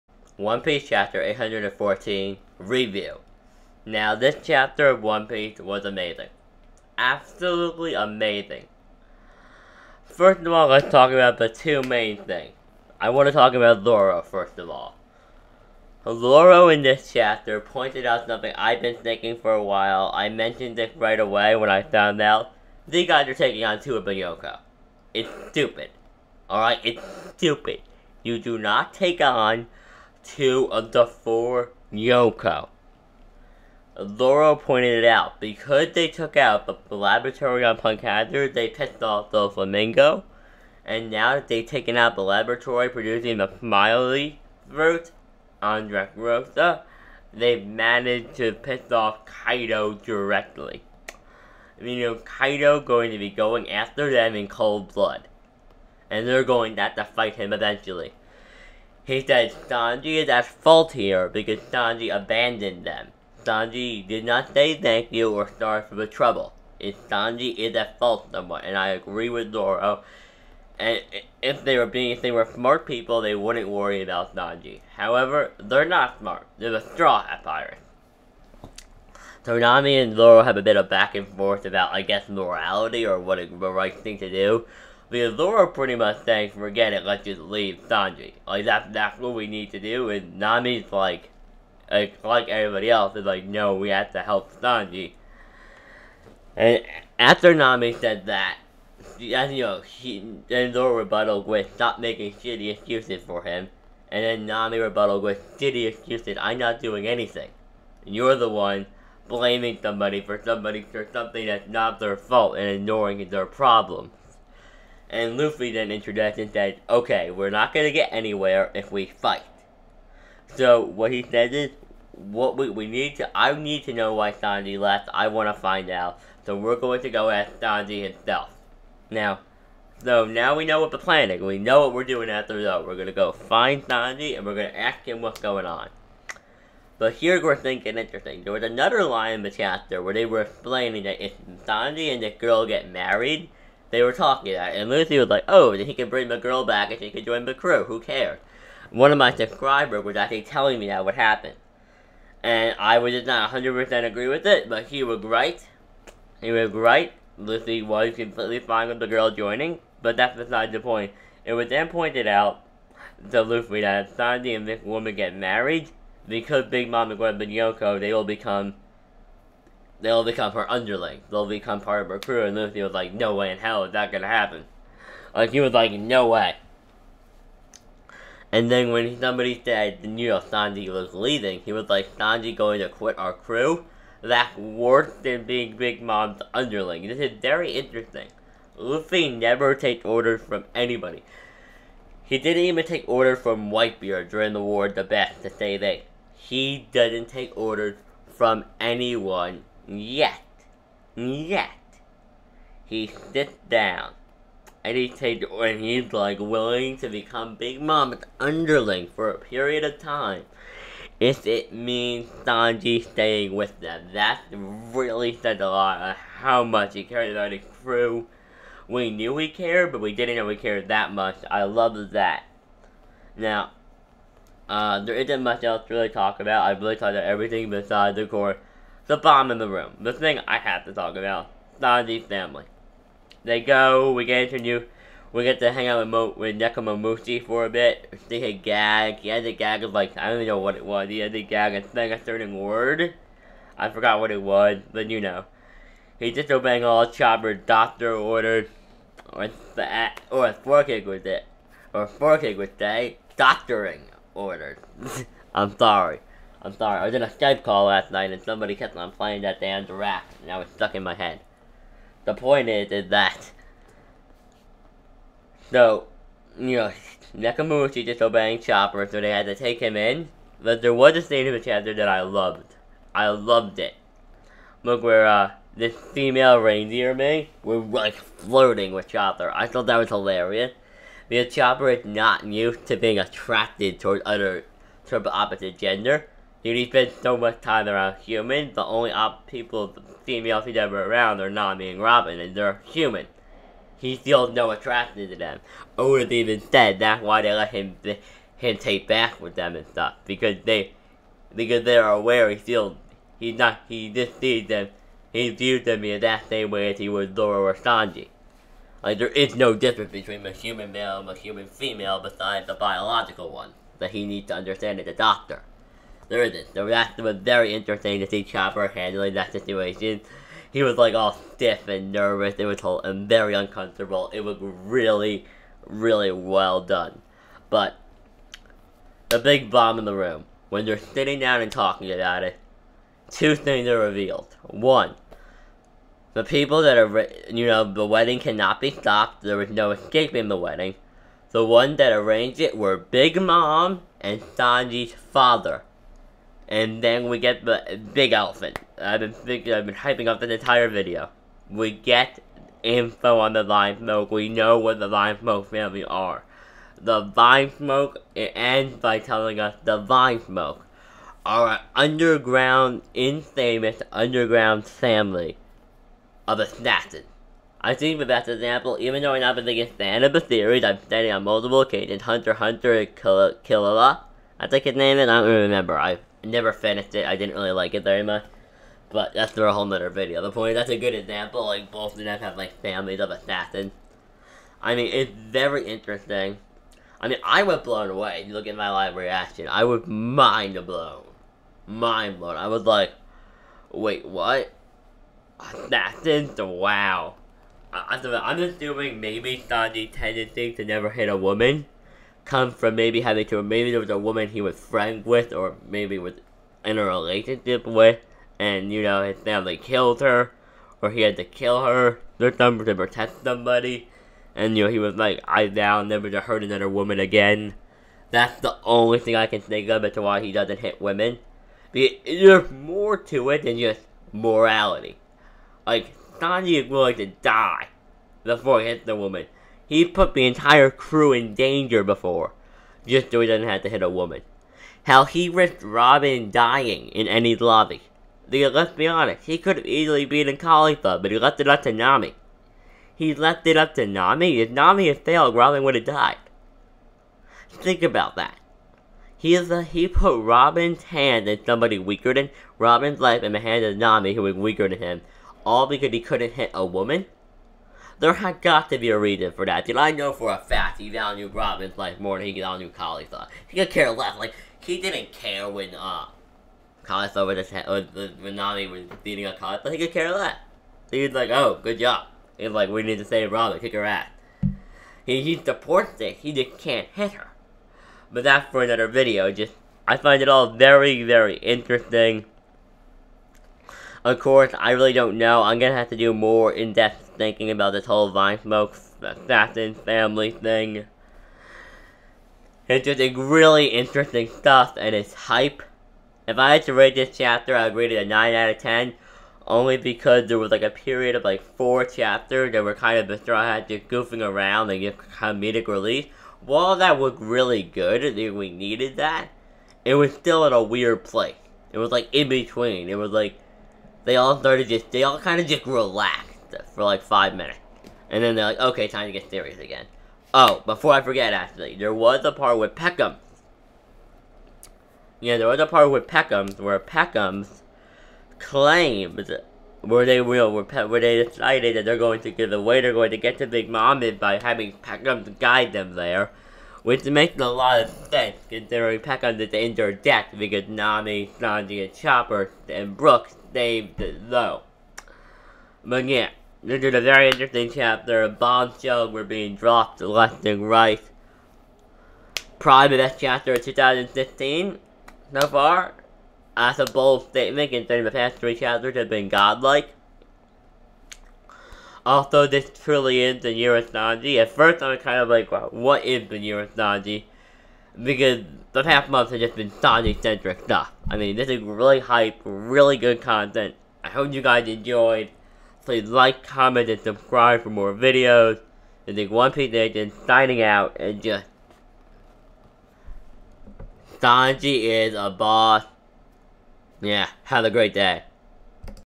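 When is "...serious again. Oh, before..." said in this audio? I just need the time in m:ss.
8:39.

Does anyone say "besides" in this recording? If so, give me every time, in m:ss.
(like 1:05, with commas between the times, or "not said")
2:40, 3:47, 5:12.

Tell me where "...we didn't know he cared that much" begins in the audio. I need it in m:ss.
3:40.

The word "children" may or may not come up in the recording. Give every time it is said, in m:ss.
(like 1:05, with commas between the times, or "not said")
not said.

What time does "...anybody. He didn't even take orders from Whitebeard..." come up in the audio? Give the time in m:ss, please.
3:10.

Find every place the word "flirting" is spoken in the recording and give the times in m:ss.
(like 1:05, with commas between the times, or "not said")
4:38.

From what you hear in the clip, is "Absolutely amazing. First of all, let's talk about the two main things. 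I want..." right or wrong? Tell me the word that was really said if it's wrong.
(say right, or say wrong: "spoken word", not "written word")
right.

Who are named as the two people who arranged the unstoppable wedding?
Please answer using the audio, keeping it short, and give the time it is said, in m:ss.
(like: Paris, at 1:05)
Big Mom and Sanji's father, at 5:42.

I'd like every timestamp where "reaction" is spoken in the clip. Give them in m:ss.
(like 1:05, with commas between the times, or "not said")
5:16, 6:29.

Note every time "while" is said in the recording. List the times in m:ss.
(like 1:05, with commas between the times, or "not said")
0:19, 8:26.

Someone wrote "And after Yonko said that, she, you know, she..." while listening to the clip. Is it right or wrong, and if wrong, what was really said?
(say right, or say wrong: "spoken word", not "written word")
wrong: "Nami", not "Yonko".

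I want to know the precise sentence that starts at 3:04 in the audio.
That's worse than being Big Mom's underling.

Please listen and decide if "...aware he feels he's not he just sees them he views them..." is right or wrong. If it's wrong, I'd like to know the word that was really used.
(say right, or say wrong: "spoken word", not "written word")
right.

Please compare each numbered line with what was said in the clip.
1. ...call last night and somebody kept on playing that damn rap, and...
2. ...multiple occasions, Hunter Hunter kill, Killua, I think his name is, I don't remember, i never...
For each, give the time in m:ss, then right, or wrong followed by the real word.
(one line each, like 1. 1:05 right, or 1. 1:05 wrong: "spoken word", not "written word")
1. 4:17 right
2. 6:11 right.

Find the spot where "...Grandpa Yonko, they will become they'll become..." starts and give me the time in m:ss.
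2:47.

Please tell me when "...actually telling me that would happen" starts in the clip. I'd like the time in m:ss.
2:30.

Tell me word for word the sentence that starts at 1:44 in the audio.
And then Nami rebutted with, shitty excuses, I'm not doing anything.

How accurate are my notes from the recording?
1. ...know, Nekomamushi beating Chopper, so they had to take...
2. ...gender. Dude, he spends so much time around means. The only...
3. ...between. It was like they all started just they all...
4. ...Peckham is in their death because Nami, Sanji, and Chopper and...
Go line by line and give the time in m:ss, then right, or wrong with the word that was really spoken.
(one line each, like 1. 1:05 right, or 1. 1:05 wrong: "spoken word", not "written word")
1. 4:26 wrong: "disobeying", not "beating"
2. 4:45 wrong: "humans", not "means"
3. 8:32 right
4. 8:59 right.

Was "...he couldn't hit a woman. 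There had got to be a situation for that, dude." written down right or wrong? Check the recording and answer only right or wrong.
wrong.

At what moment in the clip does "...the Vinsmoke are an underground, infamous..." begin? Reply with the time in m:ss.
5:59.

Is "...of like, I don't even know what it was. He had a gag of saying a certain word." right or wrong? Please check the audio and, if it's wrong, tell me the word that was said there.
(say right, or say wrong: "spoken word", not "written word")
right.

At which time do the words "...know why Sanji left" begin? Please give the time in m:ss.
2:03.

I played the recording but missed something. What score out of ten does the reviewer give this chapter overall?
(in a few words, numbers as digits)
9.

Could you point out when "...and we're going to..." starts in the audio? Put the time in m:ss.
2:14.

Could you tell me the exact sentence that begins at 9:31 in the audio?
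I mean, this is really hype, really good content.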